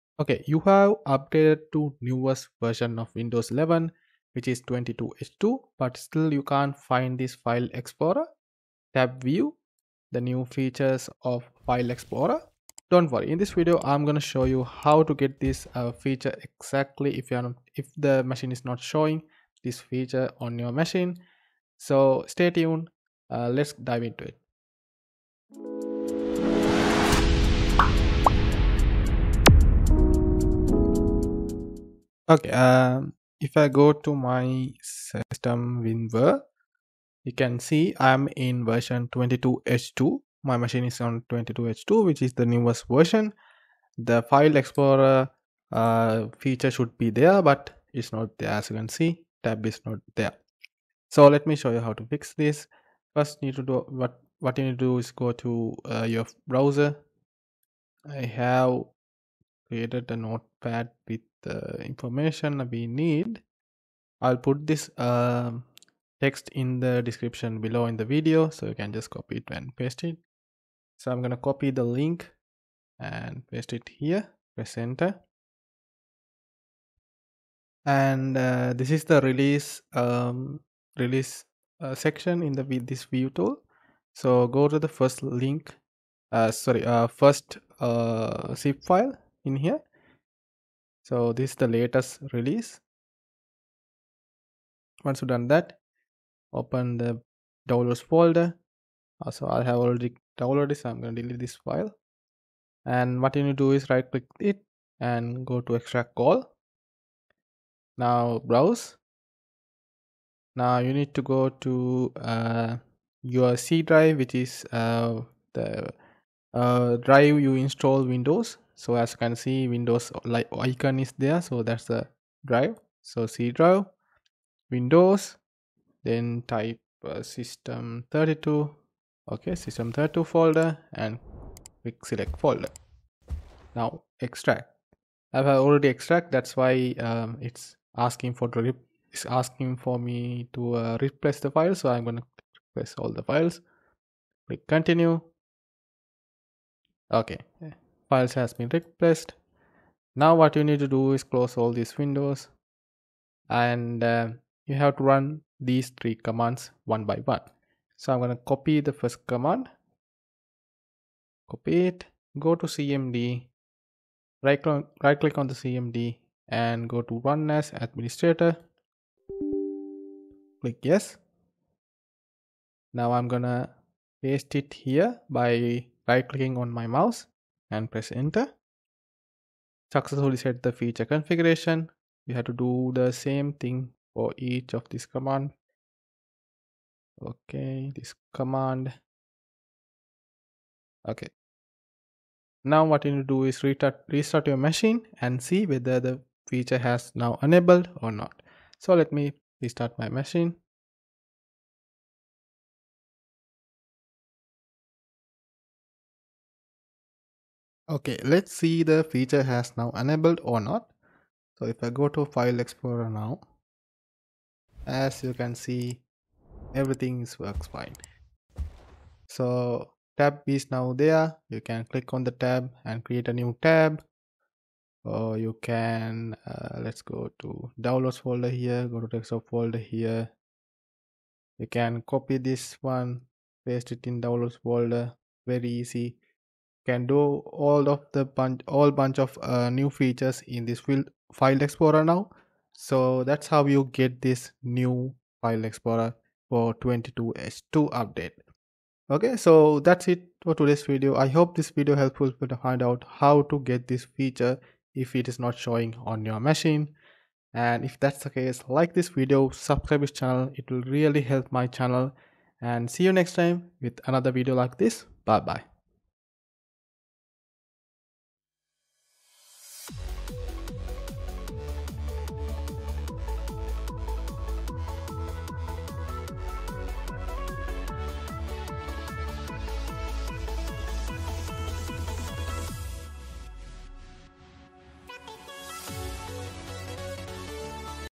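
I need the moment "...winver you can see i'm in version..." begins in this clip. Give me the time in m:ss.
0:35.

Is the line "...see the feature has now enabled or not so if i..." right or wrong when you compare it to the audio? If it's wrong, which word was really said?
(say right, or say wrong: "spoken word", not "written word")
right.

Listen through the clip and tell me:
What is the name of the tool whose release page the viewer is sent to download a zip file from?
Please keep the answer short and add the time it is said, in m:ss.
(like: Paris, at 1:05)
ViVeTool, at 1:22.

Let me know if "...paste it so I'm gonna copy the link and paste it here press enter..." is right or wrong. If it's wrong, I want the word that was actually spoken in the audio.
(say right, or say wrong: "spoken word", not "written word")
right.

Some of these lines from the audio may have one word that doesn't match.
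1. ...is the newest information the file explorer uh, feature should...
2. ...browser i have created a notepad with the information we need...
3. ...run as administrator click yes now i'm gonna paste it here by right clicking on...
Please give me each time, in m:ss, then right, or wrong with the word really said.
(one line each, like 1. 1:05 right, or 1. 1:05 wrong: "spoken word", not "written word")
1. 0:42 wrong: "version", not "information"
2. 0:56 right
3. 2:47 right.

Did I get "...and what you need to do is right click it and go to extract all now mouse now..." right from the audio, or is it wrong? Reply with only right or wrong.
wrong.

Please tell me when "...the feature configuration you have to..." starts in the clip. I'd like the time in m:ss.
3:00.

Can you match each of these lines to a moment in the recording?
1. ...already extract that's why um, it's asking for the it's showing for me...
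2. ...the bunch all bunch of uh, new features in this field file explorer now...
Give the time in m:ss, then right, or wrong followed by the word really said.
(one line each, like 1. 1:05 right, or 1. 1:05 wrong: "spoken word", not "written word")
1. 2:15 wrong: "asking", not "showing"
2. 3:58 right.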